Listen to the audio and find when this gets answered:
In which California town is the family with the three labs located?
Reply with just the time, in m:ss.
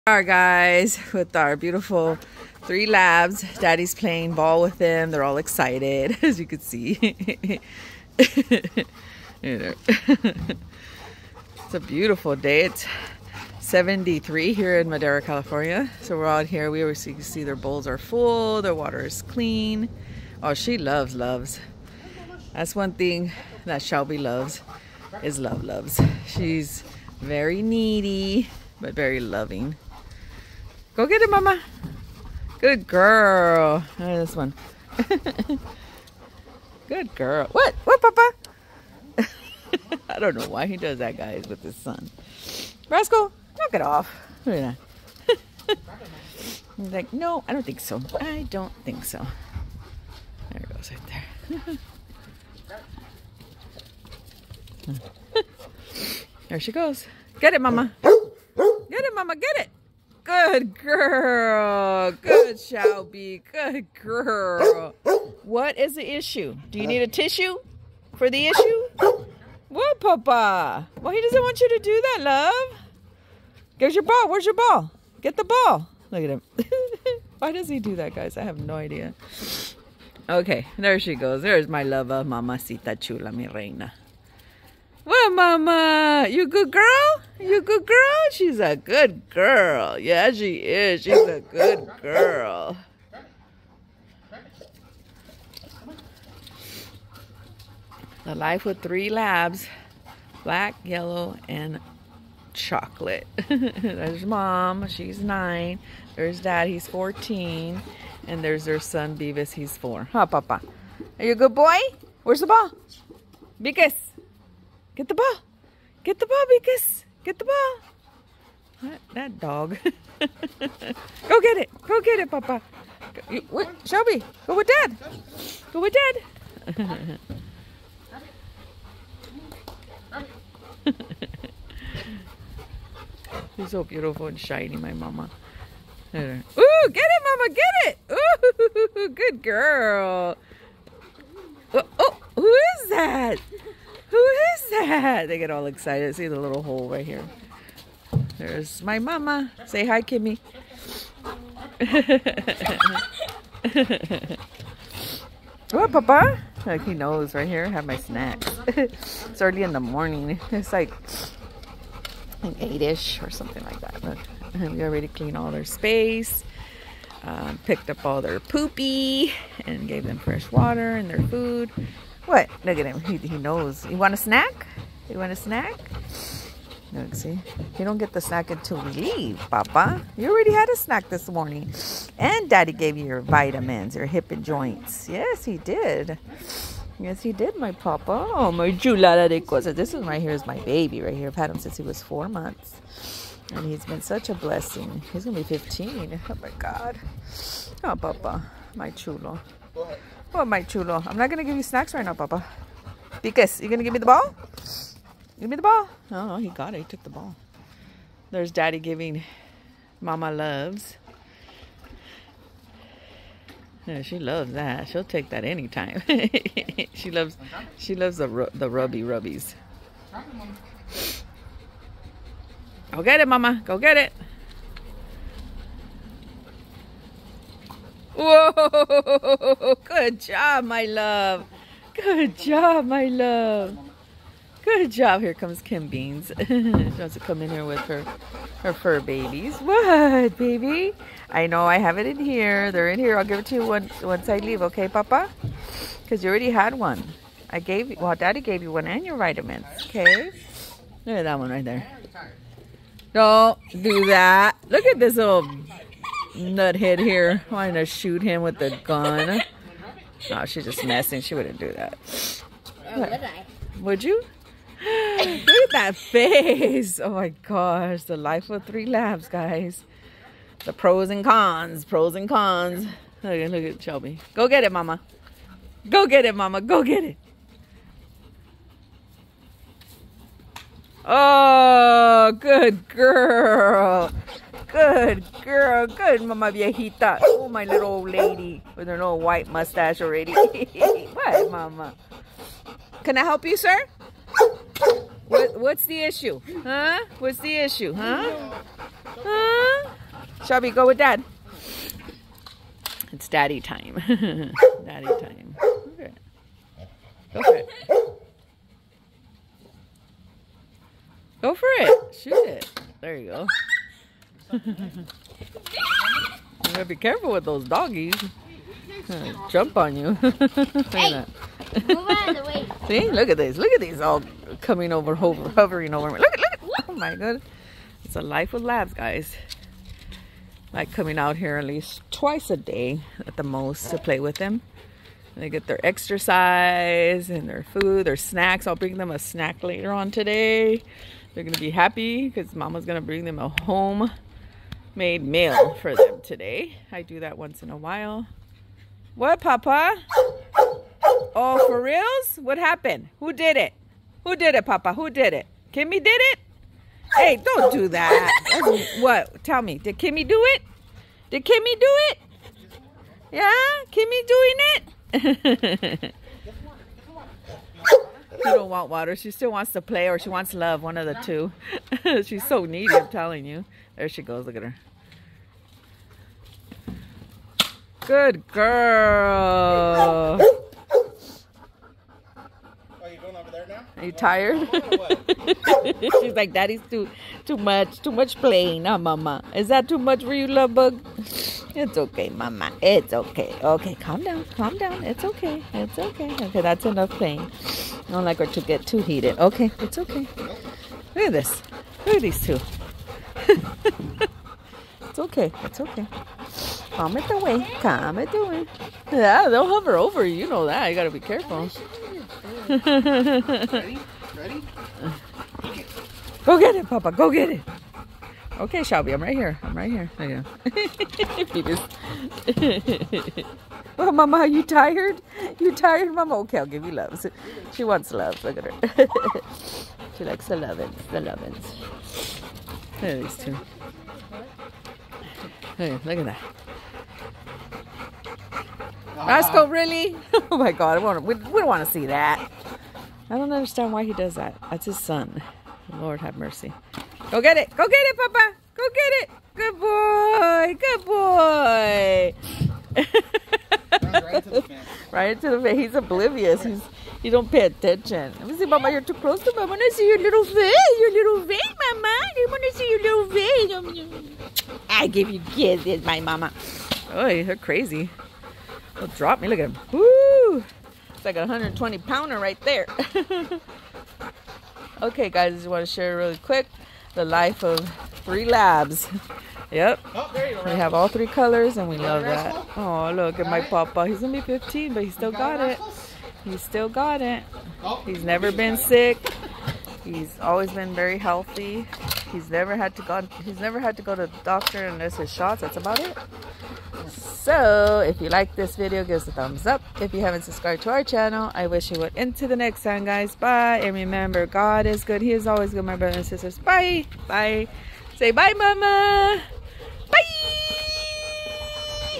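0:14.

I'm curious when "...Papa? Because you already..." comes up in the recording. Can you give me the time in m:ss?
4:04.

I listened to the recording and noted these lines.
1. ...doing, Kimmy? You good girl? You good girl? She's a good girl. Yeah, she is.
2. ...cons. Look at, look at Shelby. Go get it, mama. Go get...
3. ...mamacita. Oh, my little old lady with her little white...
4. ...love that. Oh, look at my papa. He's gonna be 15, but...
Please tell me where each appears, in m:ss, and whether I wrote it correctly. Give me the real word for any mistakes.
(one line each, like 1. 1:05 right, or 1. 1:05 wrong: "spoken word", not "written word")
1. 1:25 wrong: "Mama", not "Kimmy"
2. 4:32 right
3. 4:46 wrong: "viejita", not "mamacita"
4. 8:01 right.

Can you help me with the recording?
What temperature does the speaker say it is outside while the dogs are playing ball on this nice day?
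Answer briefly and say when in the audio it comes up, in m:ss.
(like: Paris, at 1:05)
73, at 0:13.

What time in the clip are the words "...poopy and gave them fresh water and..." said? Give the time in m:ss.
2:48.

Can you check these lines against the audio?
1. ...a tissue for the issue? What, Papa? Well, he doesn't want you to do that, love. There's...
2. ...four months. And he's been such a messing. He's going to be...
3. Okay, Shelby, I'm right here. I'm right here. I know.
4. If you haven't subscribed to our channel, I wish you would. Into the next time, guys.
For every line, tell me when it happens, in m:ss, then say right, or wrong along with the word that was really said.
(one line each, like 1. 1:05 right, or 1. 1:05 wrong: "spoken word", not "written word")
1. 1:07 right
2. 3:12 wrong: "blessing", not "messing"
3. 6:58 right
4. 8:19 right.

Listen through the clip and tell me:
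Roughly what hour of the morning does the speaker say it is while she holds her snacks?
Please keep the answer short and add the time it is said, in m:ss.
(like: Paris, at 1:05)
8-ish, at 2:42.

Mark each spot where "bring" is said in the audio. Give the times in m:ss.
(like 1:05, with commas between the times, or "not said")
5:38, 5:43.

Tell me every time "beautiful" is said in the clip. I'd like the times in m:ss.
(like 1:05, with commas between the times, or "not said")
0:01, 0:11, 2:13.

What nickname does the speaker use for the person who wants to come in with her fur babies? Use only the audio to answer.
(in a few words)
Kim Beans.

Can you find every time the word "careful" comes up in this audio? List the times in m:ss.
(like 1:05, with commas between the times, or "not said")
5:16, 6:51.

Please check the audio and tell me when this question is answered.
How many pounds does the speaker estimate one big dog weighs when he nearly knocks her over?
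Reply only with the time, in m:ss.
7:51.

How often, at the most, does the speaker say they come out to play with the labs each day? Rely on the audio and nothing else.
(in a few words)
Twice a day.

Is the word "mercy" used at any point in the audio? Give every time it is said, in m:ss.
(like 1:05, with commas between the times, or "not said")
7:26.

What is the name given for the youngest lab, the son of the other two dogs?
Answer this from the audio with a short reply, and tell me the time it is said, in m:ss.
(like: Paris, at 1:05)
Beavis, at 1:49.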